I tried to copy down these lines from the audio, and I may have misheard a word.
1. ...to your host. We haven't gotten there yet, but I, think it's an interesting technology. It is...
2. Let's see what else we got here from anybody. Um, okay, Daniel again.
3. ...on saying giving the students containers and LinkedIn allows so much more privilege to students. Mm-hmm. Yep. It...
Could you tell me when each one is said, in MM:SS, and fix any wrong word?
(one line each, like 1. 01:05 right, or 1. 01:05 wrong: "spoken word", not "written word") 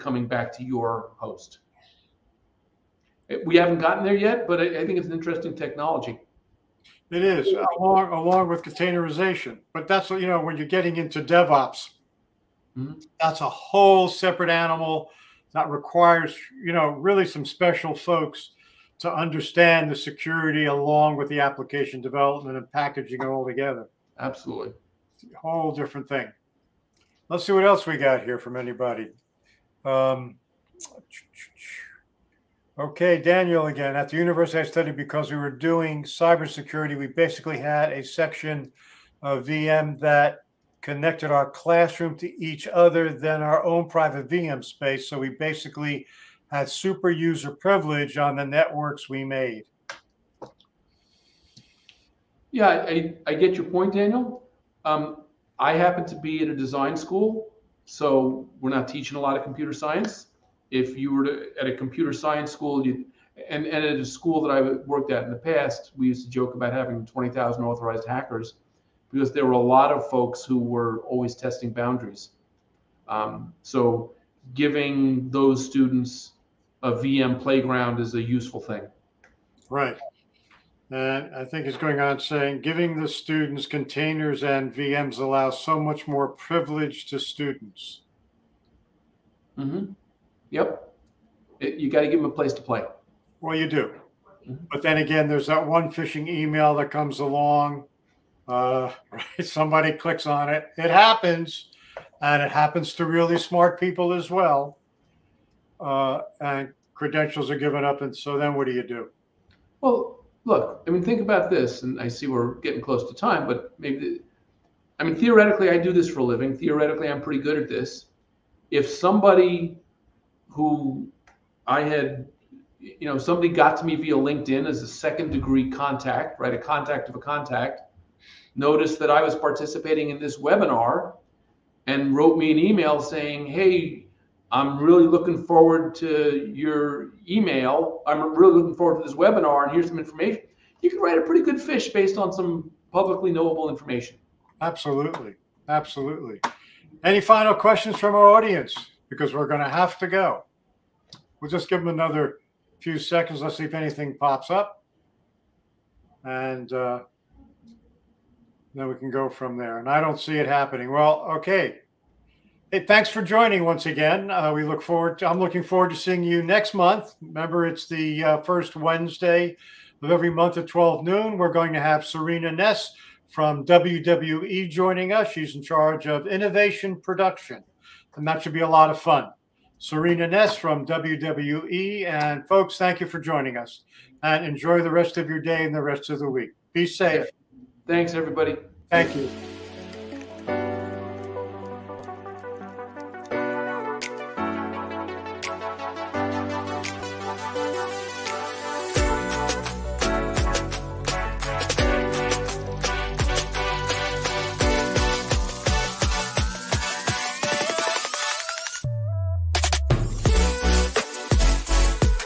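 1. 00:00 right
2. 00:27 right
3. 01:22 wrong: "VMs", not "LinkedIn".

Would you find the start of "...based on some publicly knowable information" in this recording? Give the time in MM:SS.
02:21.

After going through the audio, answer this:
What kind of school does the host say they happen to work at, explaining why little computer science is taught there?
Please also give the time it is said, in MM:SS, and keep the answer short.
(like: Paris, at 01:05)
Design school, at 00:56.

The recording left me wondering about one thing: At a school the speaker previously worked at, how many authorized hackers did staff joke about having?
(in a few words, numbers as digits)
20,000.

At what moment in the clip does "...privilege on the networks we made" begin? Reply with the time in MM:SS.
00:47.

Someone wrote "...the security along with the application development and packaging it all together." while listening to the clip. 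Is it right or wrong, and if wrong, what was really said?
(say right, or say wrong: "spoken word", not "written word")
right.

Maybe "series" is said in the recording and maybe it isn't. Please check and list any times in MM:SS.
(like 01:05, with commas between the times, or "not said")
not said.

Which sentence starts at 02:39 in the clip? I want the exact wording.
And I don't see it happening.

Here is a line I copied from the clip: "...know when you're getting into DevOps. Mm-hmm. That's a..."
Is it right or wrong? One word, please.
right.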